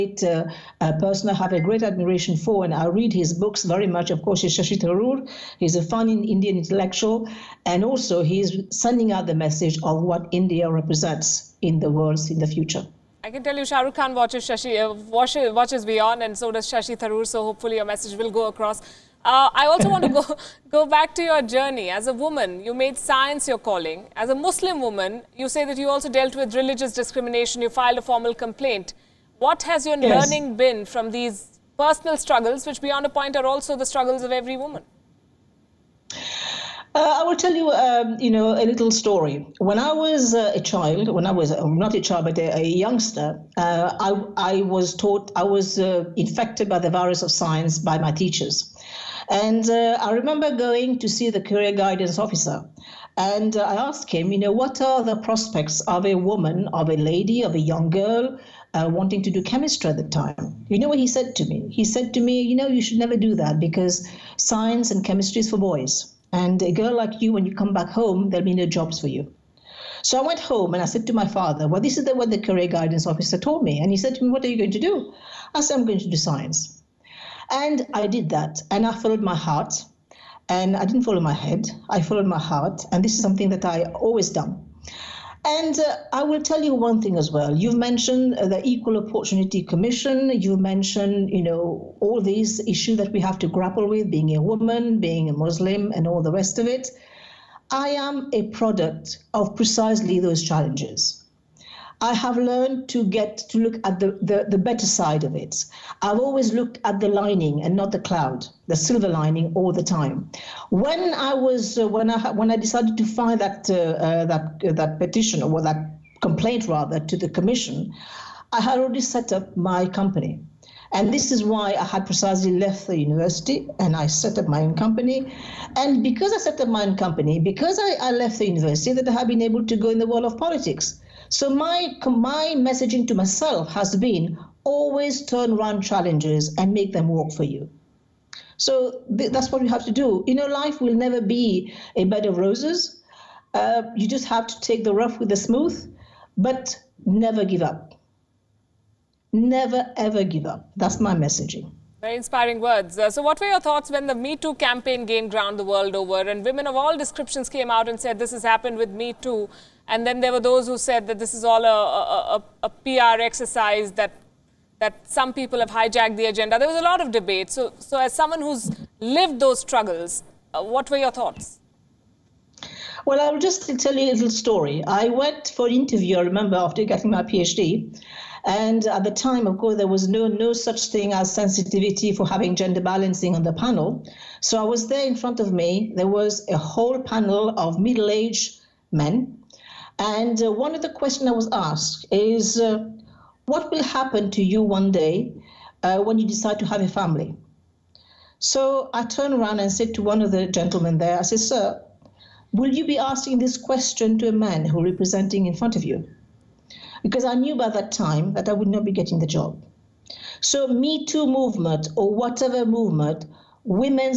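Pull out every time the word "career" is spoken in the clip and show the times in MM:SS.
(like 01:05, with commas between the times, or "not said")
00:51, 01:12.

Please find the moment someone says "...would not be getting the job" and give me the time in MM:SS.
03:28.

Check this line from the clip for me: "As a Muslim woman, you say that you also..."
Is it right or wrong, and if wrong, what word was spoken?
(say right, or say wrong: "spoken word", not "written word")
right.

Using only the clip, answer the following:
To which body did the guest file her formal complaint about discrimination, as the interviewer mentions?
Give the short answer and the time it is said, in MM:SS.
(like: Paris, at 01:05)
Equal Opportunity Commission, at 01:28.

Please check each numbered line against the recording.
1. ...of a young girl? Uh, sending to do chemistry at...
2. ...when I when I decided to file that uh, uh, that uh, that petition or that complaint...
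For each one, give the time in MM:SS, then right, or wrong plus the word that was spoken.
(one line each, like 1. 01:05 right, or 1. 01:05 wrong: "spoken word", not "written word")
1. 00:57 wrong: "wanting", not "sending"
2. 01:51 right.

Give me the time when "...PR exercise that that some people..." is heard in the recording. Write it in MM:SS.
02:42.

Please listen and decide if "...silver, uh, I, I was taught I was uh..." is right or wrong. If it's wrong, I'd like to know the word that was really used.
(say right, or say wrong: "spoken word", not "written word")
wrong: "youngster", not "silver".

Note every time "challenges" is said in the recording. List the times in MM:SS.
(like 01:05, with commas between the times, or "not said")
01:40, 02:15.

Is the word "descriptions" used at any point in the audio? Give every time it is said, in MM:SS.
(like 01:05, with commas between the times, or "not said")
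02:36.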